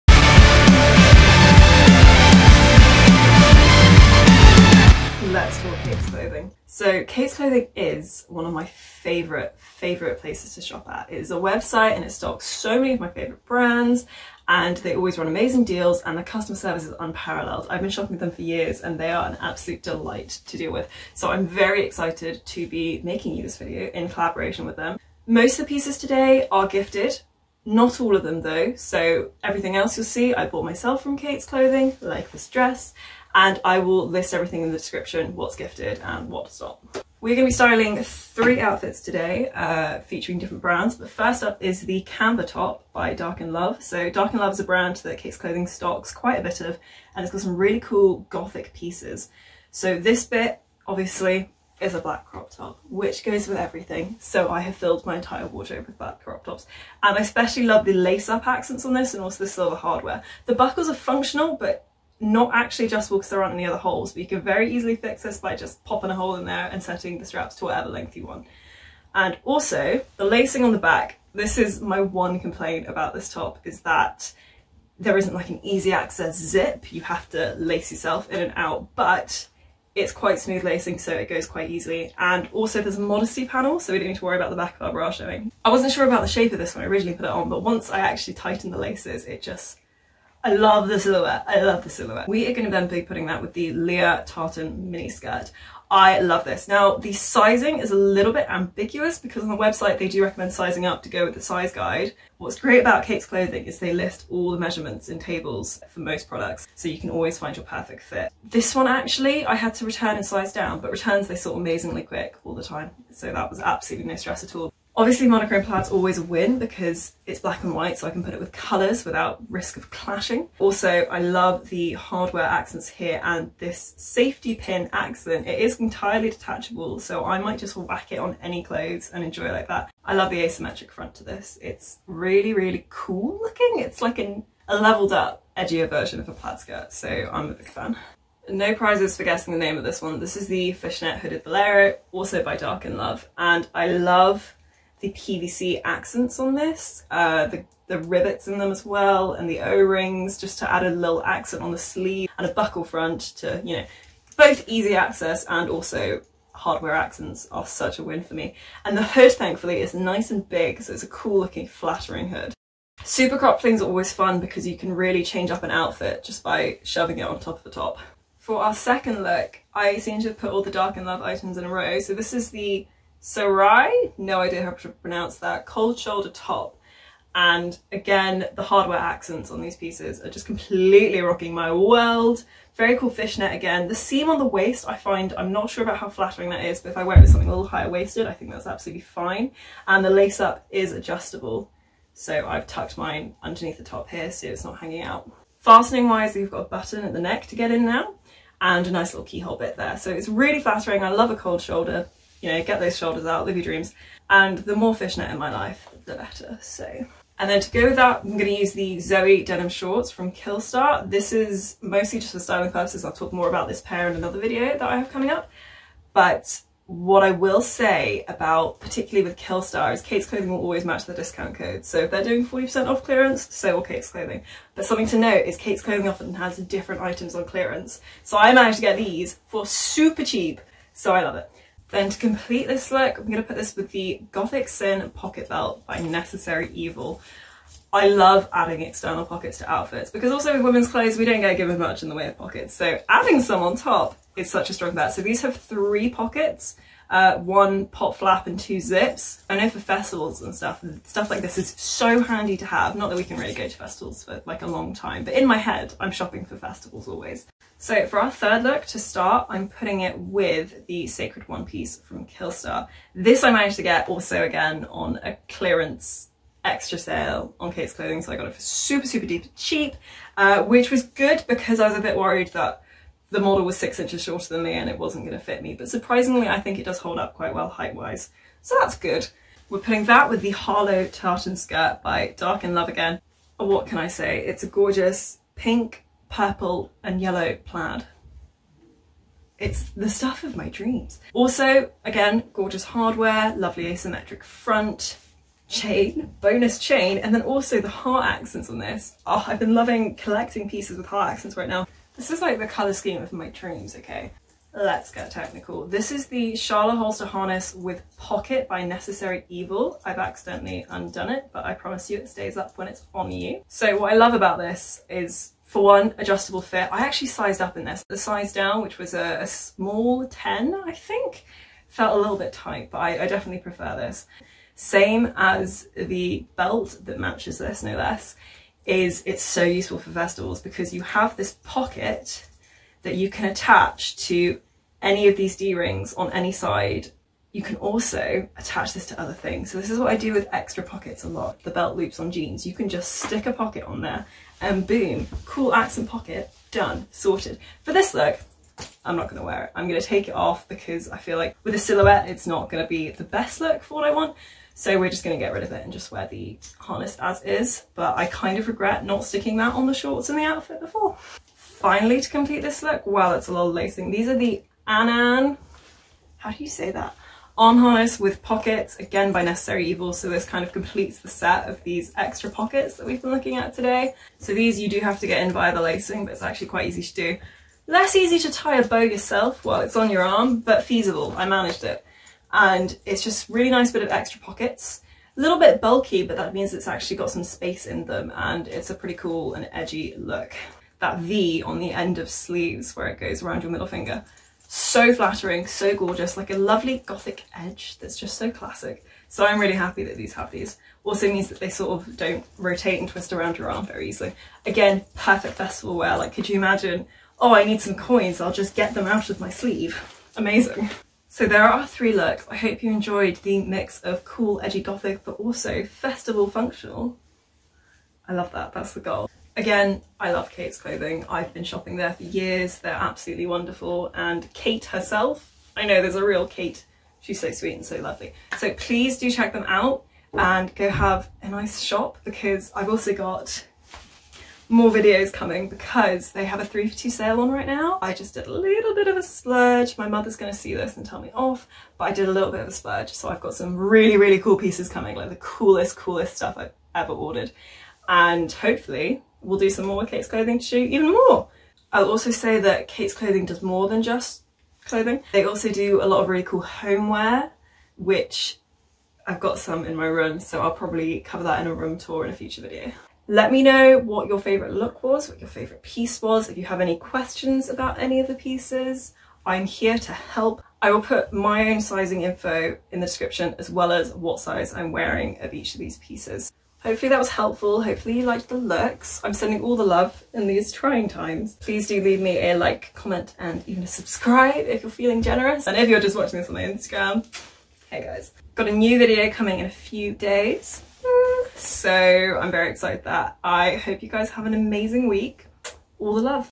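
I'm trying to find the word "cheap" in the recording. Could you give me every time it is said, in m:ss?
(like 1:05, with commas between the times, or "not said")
3:50, 4:29.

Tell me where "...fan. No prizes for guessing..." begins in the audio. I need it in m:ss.
2:17.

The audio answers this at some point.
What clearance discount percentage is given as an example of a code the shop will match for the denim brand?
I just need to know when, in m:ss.
3:42.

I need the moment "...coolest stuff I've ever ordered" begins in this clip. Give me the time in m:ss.
7:25.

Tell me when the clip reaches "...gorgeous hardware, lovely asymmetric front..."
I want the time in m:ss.
4:52.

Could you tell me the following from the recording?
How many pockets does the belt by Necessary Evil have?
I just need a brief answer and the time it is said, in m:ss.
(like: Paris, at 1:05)
3, at 4:05.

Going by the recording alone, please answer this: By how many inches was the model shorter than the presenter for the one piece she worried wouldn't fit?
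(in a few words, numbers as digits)
6.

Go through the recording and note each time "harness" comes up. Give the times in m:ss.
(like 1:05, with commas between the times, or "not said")
5:07, 5:56, 6:07.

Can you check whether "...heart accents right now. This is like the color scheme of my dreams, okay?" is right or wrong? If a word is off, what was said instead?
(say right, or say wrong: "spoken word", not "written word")
right.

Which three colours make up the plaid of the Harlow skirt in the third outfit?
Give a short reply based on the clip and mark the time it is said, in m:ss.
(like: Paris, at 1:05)
pink, purple and yellow, at 4:45.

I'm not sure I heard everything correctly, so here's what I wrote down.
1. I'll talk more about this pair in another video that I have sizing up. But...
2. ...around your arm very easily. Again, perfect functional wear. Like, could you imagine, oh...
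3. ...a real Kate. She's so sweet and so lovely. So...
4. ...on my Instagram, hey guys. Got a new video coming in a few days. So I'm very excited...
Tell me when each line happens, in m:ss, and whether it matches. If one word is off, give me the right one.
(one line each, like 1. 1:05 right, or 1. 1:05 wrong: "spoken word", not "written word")
1. 3:33 wrong: "coming", not "sizing"
2. 6:43 wrong: "festival", not "functional"
3. 7:06 right
4. 8:06 right.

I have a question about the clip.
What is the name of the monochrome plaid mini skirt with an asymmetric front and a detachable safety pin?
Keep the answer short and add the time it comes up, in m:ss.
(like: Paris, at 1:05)
Leah Tartan mini skirt, at 1:33.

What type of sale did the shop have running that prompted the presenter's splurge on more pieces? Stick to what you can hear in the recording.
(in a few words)
3 for 2.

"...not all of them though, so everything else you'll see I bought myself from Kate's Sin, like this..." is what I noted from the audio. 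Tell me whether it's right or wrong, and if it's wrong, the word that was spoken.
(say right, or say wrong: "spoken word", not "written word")
wrong: "Clothing", not "Sin".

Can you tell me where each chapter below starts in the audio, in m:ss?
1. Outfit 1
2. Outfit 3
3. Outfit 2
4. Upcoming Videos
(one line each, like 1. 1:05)
1. 0:41
2. 4:18
3. 2:48
4. 6:59.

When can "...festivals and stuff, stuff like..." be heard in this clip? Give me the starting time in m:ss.
4:09.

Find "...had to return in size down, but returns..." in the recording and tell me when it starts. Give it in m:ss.
1:49.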